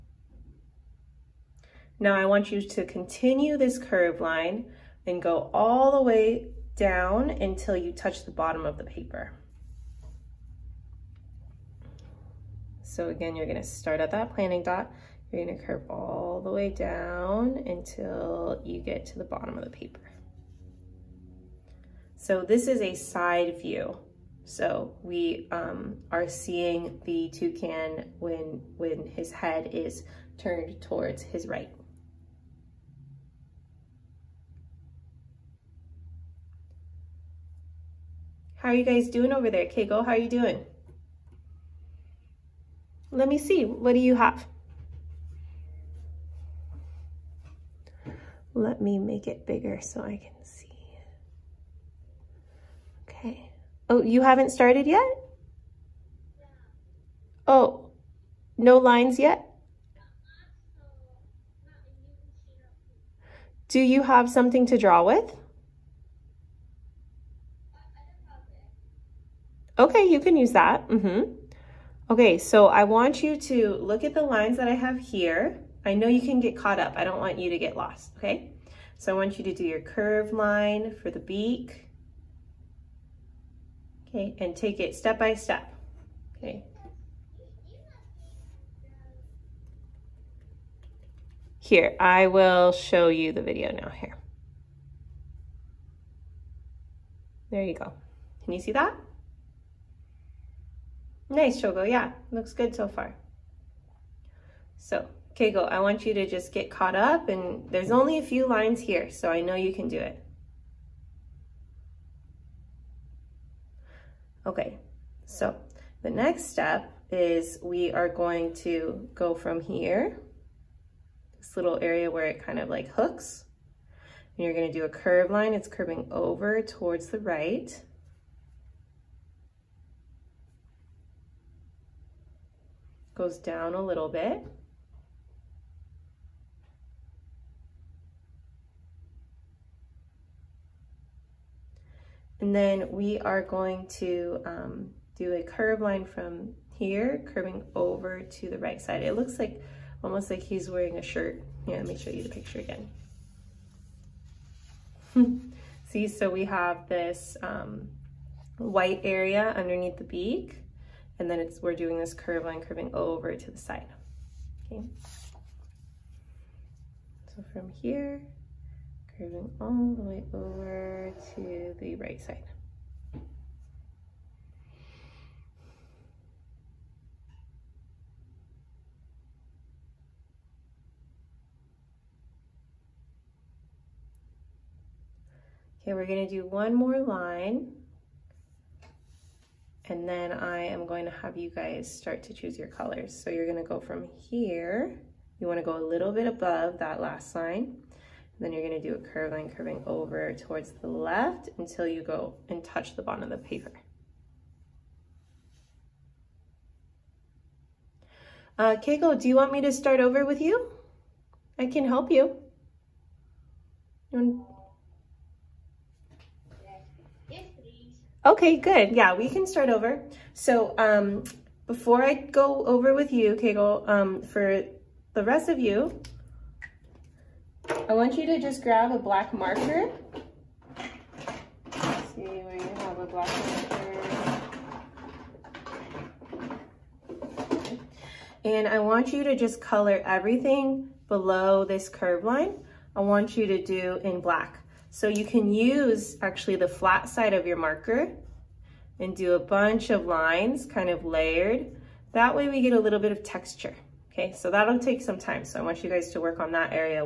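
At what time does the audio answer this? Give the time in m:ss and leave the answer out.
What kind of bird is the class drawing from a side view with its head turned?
0:27.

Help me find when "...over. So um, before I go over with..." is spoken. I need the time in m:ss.
3:39.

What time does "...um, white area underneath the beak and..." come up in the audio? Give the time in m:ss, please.
2:37.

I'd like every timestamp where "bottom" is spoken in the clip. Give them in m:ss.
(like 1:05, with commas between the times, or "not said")
0:08, 0:19, 3:23.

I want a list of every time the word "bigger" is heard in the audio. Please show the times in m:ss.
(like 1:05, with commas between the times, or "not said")
0:49.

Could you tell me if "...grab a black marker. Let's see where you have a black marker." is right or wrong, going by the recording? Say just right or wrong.
right.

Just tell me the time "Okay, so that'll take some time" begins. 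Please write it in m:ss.
4:14.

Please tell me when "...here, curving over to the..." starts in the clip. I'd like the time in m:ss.
2:26.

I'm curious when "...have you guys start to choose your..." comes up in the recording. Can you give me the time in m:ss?
3:11.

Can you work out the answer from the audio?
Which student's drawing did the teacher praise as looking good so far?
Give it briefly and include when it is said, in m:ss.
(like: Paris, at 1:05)
Shogo, at 1:41.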